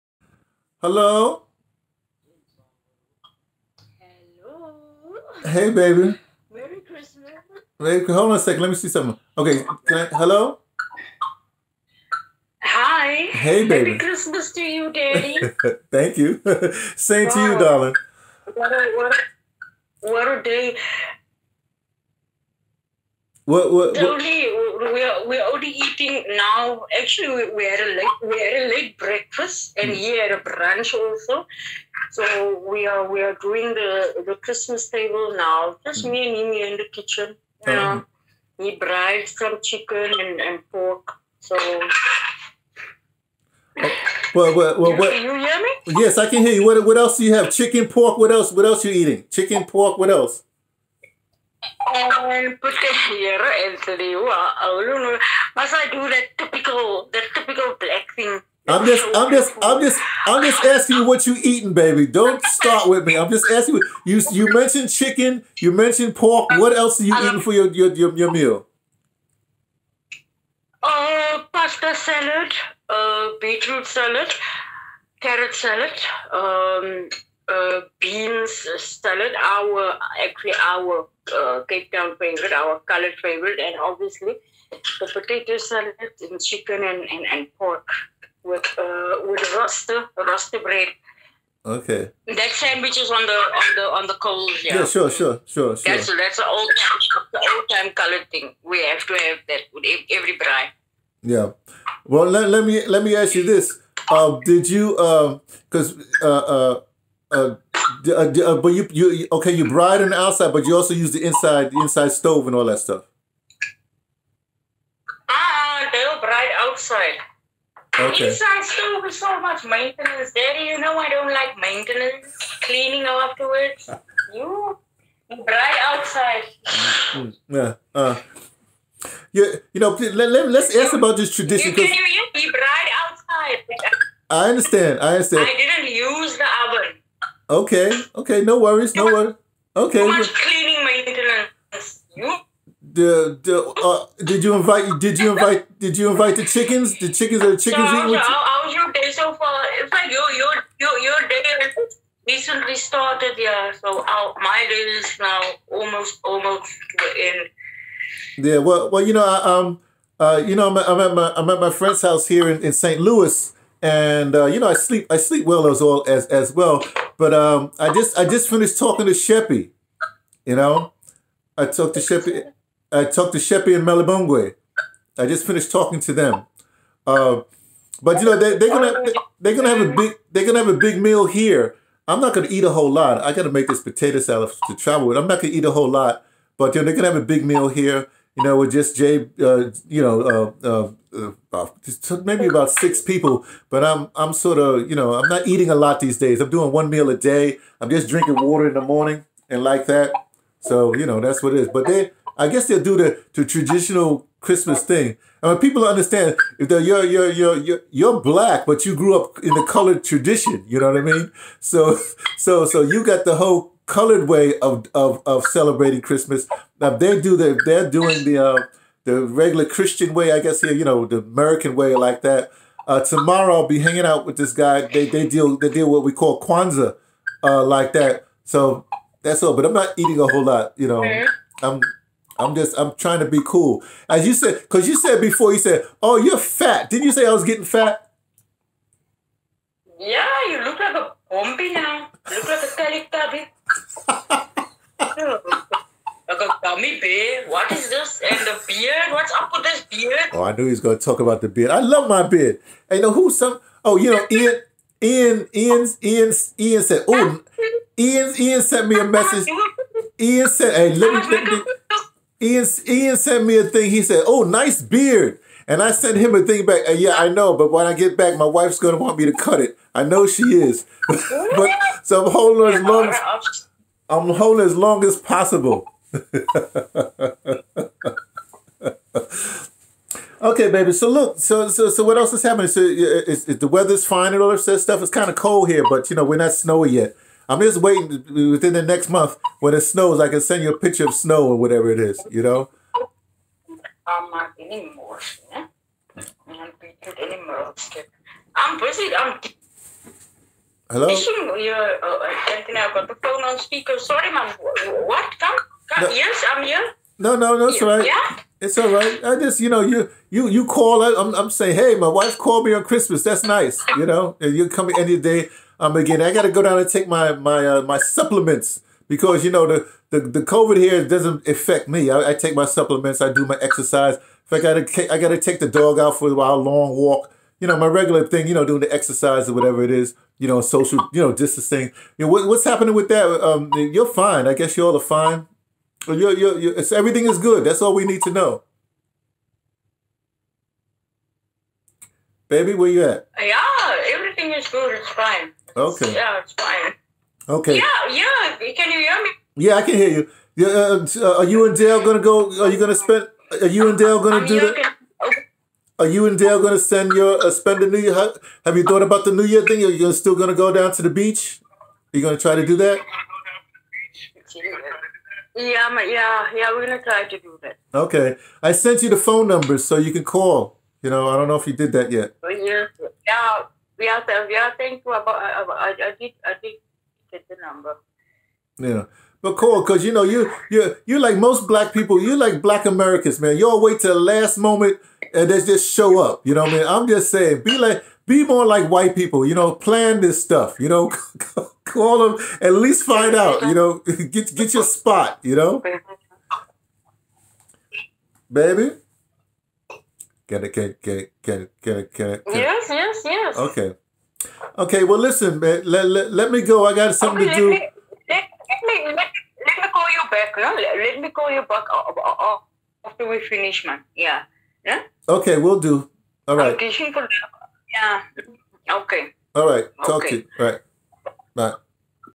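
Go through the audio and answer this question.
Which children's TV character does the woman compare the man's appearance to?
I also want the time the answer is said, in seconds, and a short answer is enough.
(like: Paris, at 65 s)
Teletubby, at 242 s.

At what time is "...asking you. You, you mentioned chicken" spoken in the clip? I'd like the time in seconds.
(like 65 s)
63 s.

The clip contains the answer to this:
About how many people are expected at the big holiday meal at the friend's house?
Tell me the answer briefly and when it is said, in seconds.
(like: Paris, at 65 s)
6, at 192 s.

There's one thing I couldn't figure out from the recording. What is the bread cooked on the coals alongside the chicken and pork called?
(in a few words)
roaster bread.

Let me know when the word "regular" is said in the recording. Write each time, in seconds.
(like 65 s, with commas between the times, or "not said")
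219 s, 327 s.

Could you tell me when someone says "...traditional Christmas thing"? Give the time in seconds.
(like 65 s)
203 s.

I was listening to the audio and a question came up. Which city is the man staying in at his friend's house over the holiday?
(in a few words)
St. Louis.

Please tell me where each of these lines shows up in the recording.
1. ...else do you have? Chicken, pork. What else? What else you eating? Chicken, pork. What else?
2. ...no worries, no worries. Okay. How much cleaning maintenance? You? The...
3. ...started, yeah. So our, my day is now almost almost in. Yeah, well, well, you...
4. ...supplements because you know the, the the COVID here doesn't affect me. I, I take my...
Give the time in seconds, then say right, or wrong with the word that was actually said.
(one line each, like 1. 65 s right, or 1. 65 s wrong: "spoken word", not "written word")
1. 46 s right
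2. 138 s right
3. 152 s right
4. 317 s right.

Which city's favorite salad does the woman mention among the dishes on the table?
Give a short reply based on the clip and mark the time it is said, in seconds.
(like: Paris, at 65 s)
Cape Town, at 81 s.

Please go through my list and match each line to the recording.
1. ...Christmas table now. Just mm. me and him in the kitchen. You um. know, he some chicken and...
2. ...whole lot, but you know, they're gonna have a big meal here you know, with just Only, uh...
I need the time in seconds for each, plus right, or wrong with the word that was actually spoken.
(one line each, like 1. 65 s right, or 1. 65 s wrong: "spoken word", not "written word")
1. 34 s right
2. 185 s wrong: "Jay", not "Only".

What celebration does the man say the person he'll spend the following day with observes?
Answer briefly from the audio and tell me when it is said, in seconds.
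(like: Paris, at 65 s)
Kwanzaa, at 226 s.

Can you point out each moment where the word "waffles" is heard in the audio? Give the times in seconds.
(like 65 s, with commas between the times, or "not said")
not said.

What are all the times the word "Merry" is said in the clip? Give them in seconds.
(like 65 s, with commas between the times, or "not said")
6 s, 13 s.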